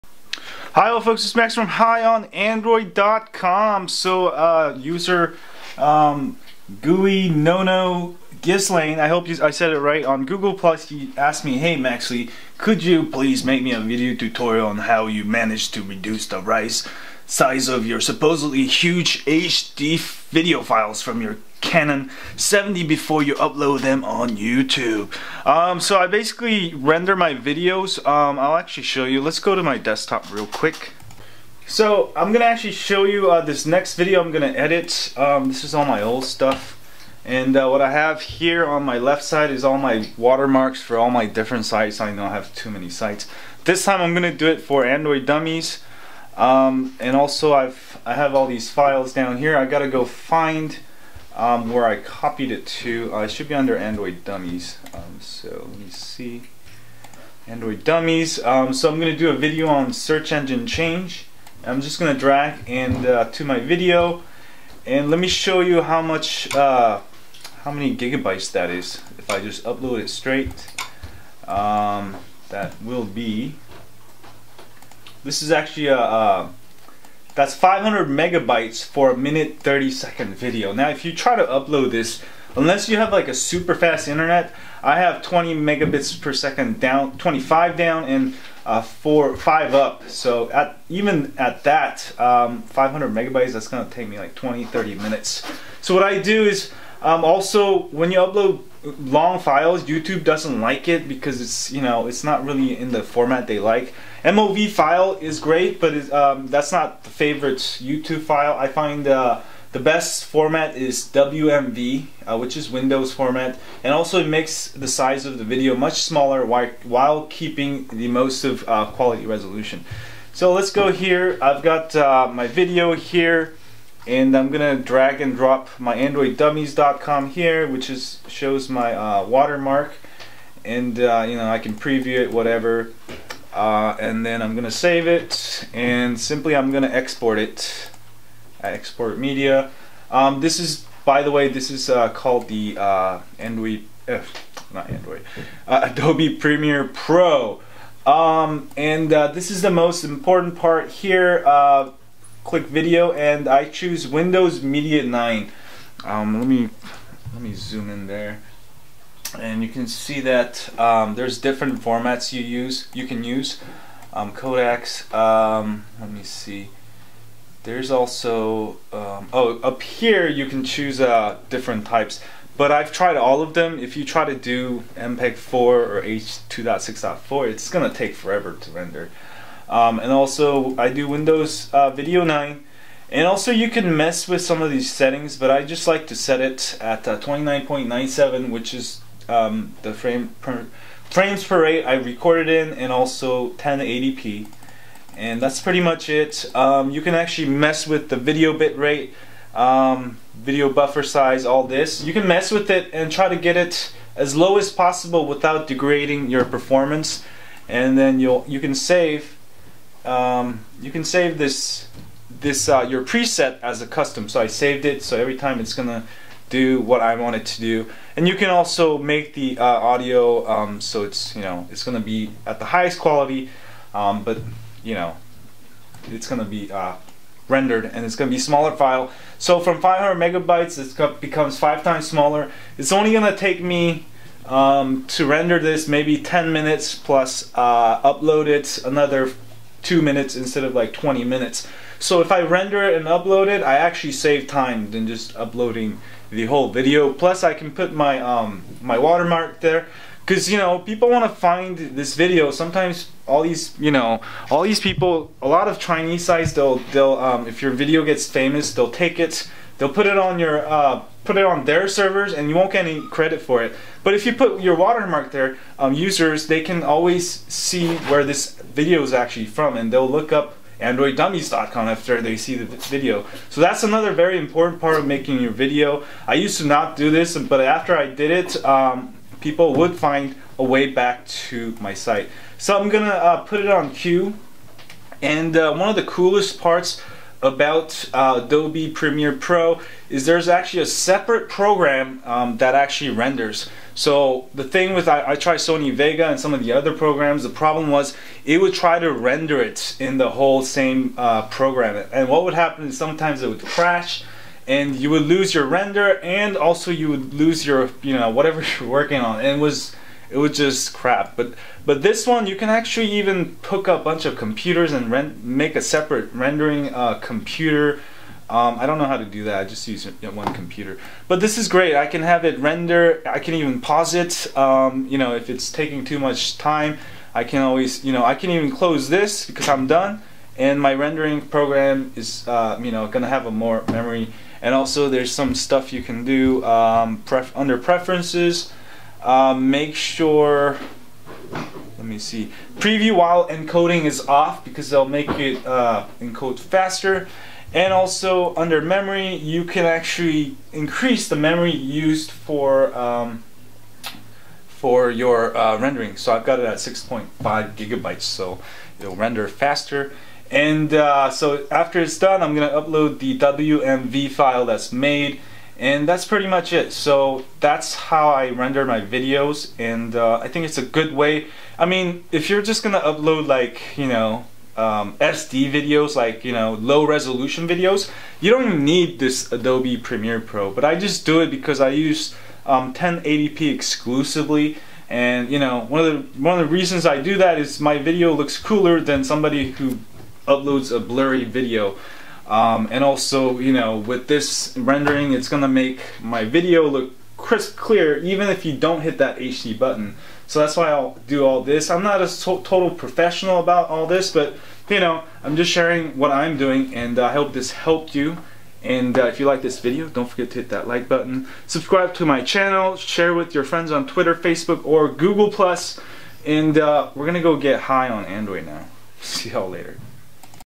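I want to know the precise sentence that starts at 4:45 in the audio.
And uh, one of the coolest parts about uh, Adobe Premiere Pro is there's actually a separate program um, that actually renders.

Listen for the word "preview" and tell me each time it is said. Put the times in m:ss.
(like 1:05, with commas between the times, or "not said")
2:11, 5:42.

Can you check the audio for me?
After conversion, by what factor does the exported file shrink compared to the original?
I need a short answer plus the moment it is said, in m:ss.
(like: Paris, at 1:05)
5 times smaller, at 3:51.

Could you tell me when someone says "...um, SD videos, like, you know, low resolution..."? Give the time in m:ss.
6:14.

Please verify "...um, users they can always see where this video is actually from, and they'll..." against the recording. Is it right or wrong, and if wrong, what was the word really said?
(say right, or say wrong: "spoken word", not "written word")
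right.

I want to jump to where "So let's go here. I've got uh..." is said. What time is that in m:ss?
2:00.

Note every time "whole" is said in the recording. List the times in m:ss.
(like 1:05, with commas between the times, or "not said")
4:06, 5:00.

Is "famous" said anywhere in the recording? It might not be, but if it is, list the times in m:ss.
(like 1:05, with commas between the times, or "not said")
4:18.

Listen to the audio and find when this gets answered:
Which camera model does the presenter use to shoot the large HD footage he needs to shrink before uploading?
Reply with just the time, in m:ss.
0:21.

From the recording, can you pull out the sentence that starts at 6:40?
So that's why I'll do all this.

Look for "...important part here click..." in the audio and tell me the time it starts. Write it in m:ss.
2:30.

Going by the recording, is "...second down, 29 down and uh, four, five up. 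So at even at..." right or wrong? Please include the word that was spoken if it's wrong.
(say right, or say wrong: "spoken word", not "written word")
wrong: "25", not "29".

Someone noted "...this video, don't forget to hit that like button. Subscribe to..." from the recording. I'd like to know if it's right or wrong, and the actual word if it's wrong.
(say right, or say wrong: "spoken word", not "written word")
right.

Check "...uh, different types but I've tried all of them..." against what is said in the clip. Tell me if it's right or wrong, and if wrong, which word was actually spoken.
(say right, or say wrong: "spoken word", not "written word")
right.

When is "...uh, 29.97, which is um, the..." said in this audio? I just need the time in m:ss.
3:07.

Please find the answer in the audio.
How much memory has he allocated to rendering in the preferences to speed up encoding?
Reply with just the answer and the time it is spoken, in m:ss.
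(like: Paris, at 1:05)
6.5 gigabytes, at 5:56.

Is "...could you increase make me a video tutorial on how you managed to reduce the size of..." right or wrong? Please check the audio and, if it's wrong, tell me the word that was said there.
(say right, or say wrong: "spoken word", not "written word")
wrong: "please", not "increase".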